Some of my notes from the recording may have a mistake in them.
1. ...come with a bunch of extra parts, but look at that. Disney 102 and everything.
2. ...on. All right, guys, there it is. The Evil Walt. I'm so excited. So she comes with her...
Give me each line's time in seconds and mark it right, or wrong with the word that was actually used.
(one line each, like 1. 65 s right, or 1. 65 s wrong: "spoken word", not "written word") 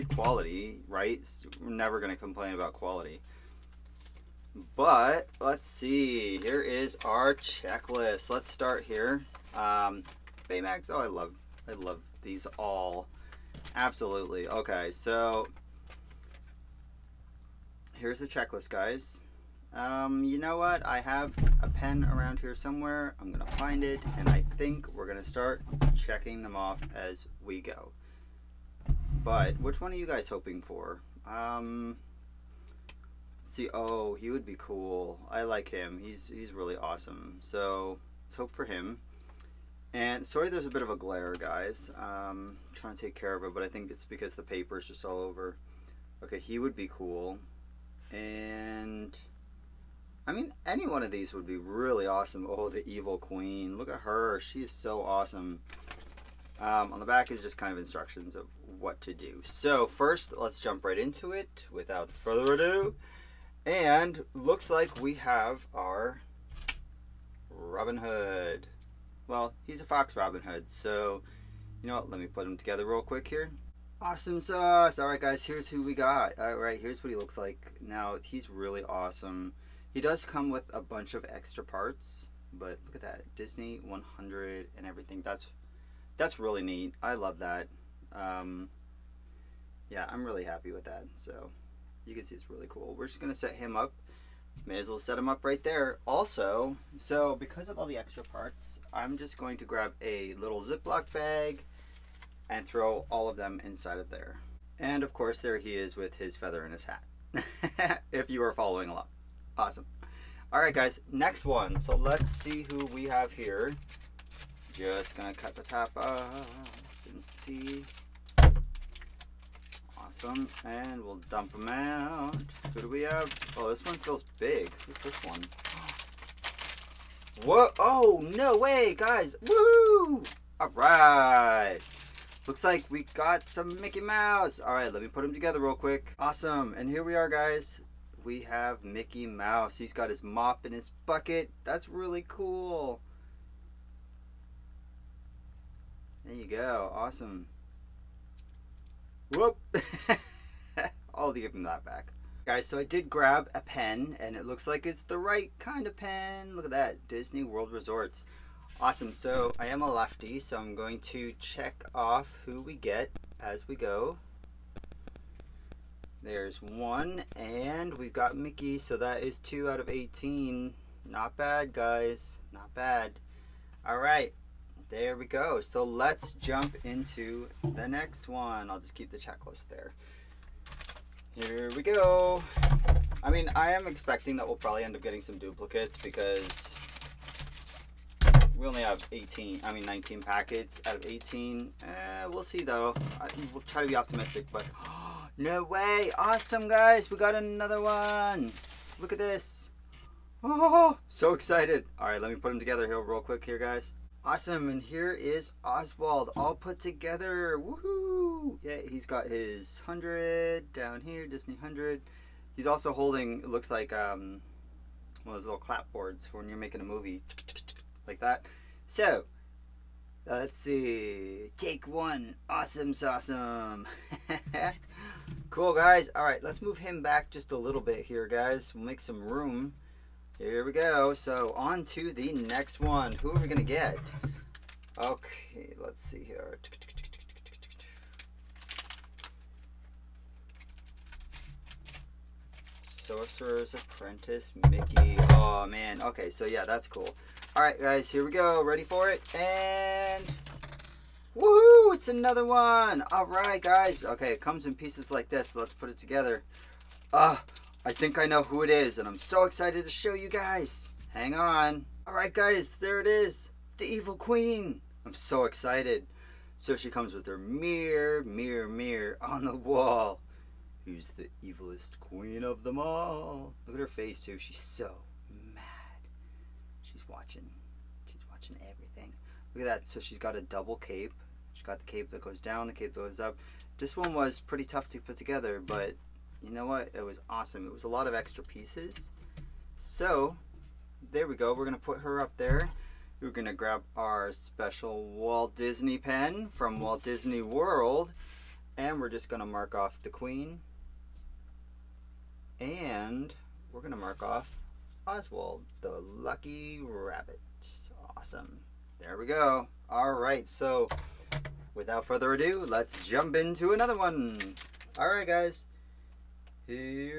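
1. 80 s wrong: "100", not "102"
2. 261 s wrong: "Queen", not "Walt".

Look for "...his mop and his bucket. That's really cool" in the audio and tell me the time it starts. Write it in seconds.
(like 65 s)
140 s.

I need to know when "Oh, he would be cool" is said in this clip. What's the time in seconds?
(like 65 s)
33 s.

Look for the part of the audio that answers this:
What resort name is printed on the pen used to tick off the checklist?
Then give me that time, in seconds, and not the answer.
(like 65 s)
157 s.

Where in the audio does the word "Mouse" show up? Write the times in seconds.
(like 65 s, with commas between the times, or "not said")
134 s, 139 s.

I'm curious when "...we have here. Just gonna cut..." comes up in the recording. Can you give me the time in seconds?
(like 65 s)
112 s.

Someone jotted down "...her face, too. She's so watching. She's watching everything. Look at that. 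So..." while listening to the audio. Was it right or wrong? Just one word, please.
right.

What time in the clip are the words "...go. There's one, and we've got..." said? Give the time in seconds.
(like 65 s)
163 s.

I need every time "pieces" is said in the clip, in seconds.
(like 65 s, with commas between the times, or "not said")
254 s, 288 s.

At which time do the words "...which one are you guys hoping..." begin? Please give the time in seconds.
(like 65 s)
29 s.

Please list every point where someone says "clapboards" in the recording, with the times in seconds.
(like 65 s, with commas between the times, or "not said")
215 s.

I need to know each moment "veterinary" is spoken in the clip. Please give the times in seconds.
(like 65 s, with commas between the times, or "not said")
not said.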